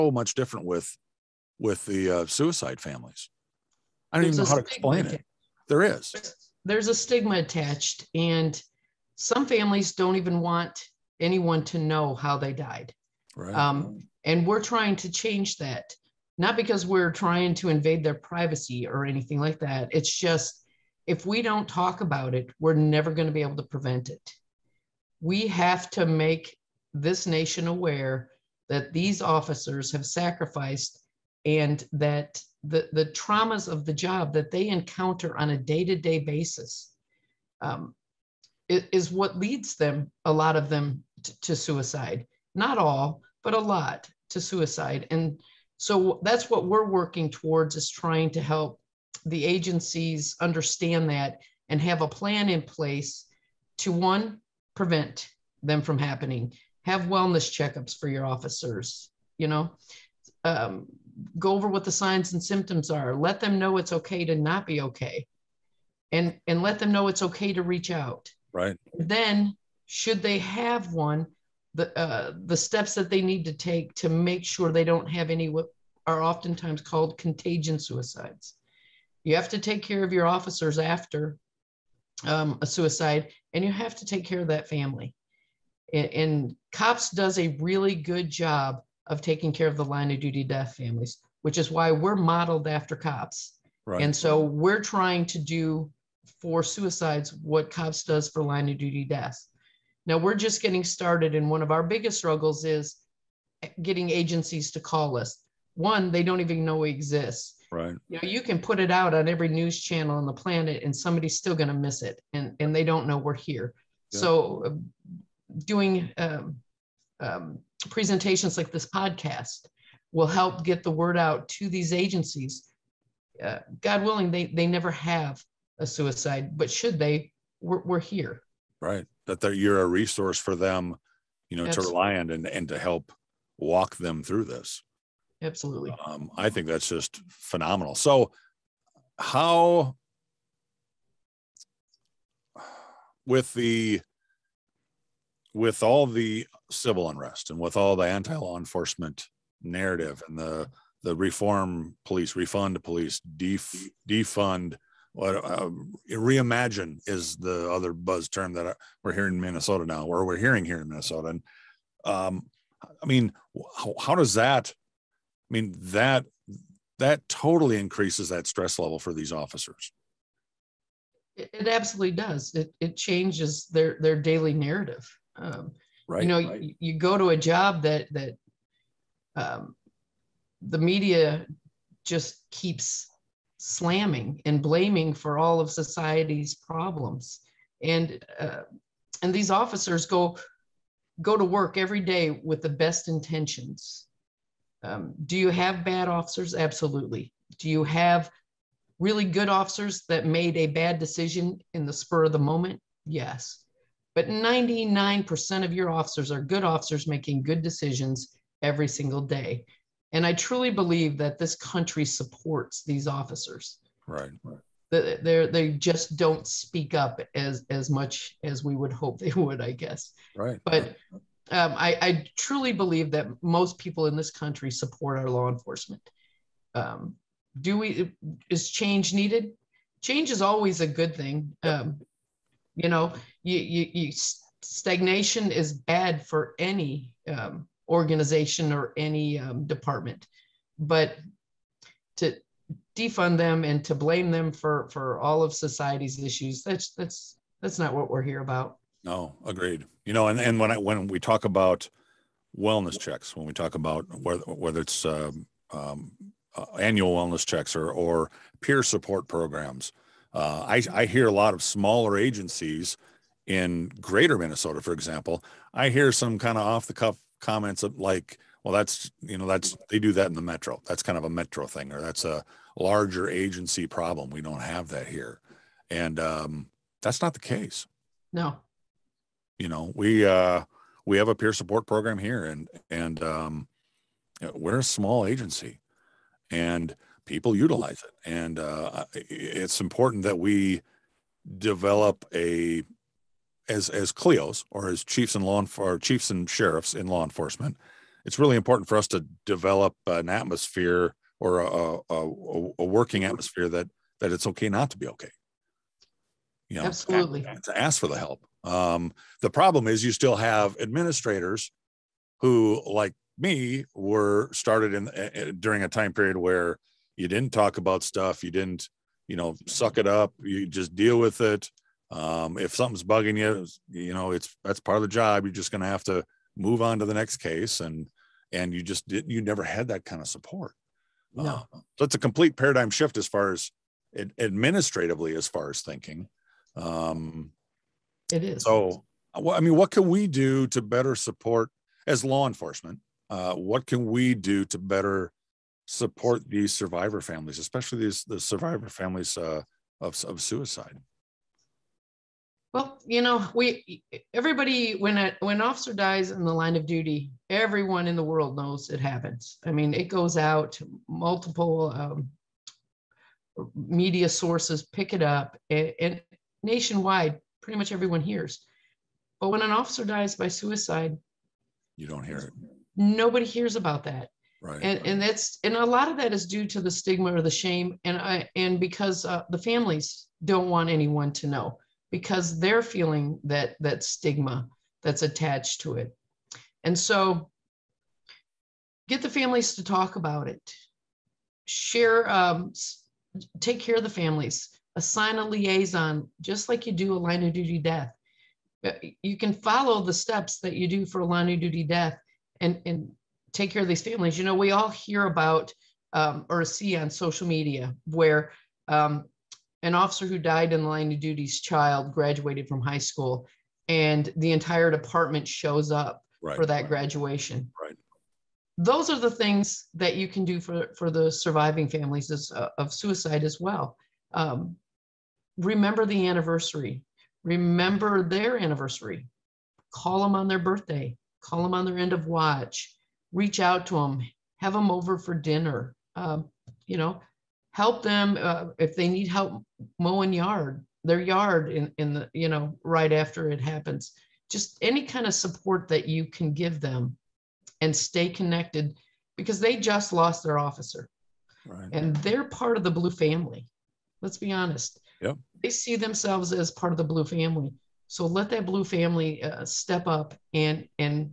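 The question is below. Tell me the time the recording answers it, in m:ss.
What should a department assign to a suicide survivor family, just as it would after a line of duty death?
6:34.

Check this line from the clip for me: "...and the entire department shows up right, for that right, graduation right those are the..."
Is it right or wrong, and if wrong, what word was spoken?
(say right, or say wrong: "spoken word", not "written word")
right.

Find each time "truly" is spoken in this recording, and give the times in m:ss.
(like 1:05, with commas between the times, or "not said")
3:30, 3:42.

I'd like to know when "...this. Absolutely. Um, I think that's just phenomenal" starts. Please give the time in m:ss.
2:14.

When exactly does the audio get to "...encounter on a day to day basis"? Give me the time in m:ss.
0:34.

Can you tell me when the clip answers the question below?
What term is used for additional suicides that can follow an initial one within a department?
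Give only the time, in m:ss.
1:17.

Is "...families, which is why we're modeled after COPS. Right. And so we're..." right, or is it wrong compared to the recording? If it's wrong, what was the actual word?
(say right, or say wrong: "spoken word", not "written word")
right.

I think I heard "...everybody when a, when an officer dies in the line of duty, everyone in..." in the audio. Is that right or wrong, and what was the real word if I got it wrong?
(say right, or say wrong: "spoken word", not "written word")
right.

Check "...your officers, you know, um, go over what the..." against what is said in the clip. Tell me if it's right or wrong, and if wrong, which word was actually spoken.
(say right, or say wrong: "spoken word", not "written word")
right.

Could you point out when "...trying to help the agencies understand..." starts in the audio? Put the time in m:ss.
0:47.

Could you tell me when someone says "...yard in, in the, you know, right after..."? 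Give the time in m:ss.
7:21.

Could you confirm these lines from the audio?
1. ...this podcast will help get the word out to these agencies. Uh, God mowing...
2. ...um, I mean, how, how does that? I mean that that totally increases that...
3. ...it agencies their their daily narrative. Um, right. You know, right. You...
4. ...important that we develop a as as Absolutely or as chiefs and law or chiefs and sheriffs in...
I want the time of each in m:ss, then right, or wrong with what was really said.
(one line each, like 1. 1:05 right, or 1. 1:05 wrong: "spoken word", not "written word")
1. 1:58 wrong: "willing", not "mowing"
2. 2:42 right
3. 2:52 wrong: "changes", not "agencies"
4. 4:49 wrong: "CLEOs", not "Absolutely".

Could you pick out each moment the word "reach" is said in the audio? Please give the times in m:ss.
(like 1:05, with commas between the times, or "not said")
1:07, 7:13.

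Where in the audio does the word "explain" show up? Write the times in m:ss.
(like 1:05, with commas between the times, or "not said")
0:04.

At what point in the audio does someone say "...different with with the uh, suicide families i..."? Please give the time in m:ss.
0:00.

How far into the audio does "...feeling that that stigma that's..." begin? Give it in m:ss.
6:22.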